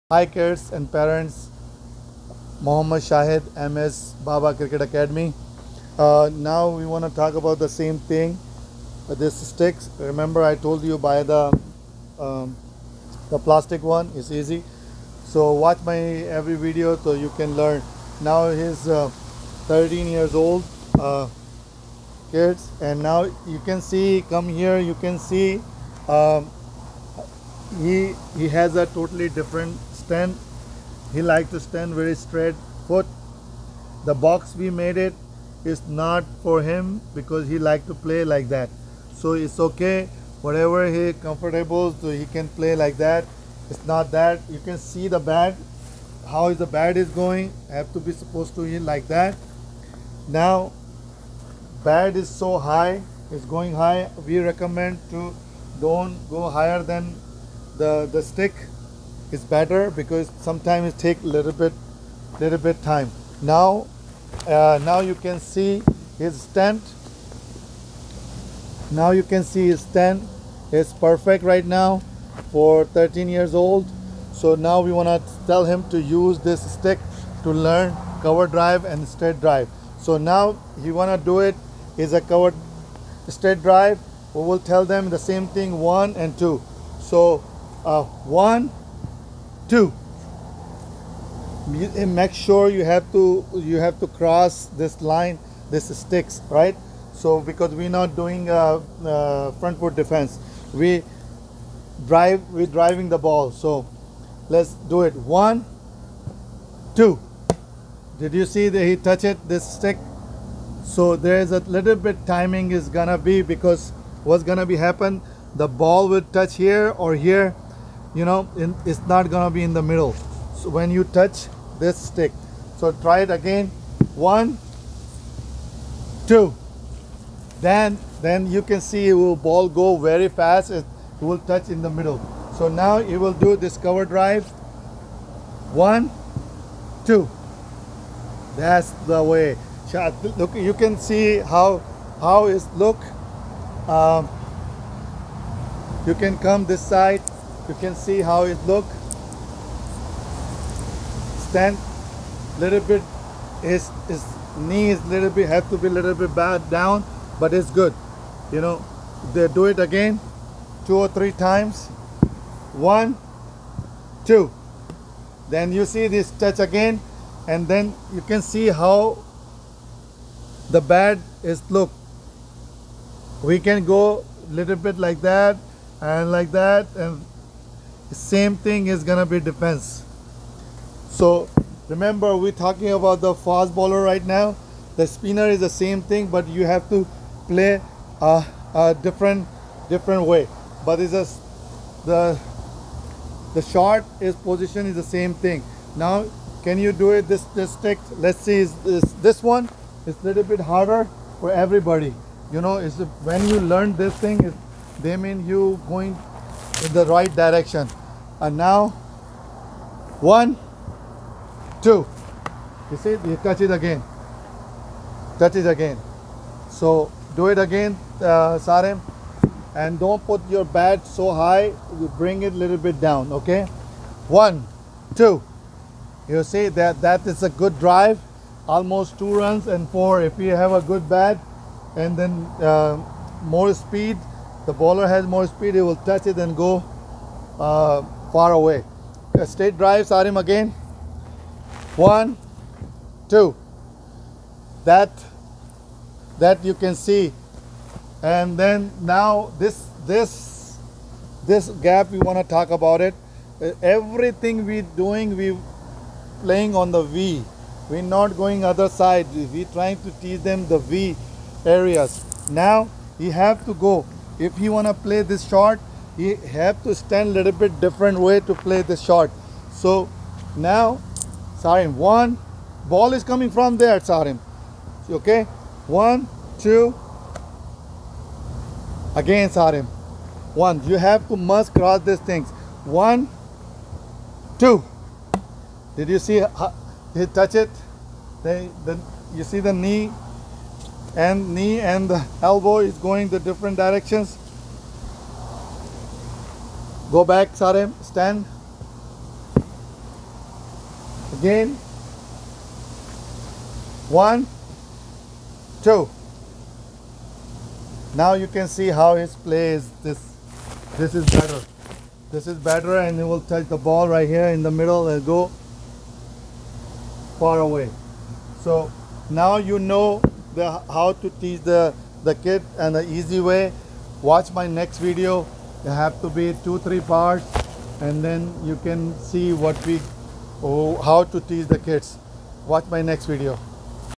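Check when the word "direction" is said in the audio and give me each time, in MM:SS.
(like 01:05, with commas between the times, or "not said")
03:27, 04:53.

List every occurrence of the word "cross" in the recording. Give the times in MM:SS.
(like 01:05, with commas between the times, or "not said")
01:34, 04:41.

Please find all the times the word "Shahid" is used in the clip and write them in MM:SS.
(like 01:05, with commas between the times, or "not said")
00:03.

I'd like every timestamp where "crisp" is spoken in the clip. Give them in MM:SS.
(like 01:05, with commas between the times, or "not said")
not said.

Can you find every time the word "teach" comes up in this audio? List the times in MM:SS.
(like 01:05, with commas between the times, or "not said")
04:20, 05:21, 05:31.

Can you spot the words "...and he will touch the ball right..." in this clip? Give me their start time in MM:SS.
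05:12.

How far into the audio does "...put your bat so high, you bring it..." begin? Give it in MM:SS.
03:40.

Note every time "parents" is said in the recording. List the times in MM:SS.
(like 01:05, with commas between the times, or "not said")
00:00.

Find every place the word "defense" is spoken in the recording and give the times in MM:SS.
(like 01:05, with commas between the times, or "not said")
01:40, 02:59.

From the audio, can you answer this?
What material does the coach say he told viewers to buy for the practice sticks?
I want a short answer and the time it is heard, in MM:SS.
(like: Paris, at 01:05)
Plastic, at 00:13.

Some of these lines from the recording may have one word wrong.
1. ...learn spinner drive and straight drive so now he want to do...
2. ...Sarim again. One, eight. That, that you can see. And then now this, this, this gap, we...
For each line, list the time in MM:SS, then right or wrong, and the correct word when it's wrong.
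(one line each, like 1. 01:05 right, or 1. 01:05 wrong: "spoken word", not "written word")
1. 01:17 wrong: "cover", not "spinner"
2. 04:00 wrong: "two", not "eight".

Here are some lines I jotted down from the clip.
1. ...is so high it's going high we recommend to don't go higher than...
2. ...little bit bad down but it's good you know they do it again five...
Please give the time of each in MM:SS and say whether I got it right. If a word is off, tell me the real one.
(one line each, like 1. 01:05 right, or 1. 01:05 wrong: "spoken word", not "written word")
1. 00:52 right
2. 02:35 wrong: "two", not "five".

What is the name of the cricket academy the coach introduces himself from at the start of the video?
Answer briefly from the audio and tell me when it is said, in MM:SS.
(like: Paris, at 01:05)
MS Baba Cricket Academy, at 00:03.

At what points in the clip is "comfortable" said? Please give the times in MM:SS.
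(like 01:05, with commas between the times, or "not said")
00:41.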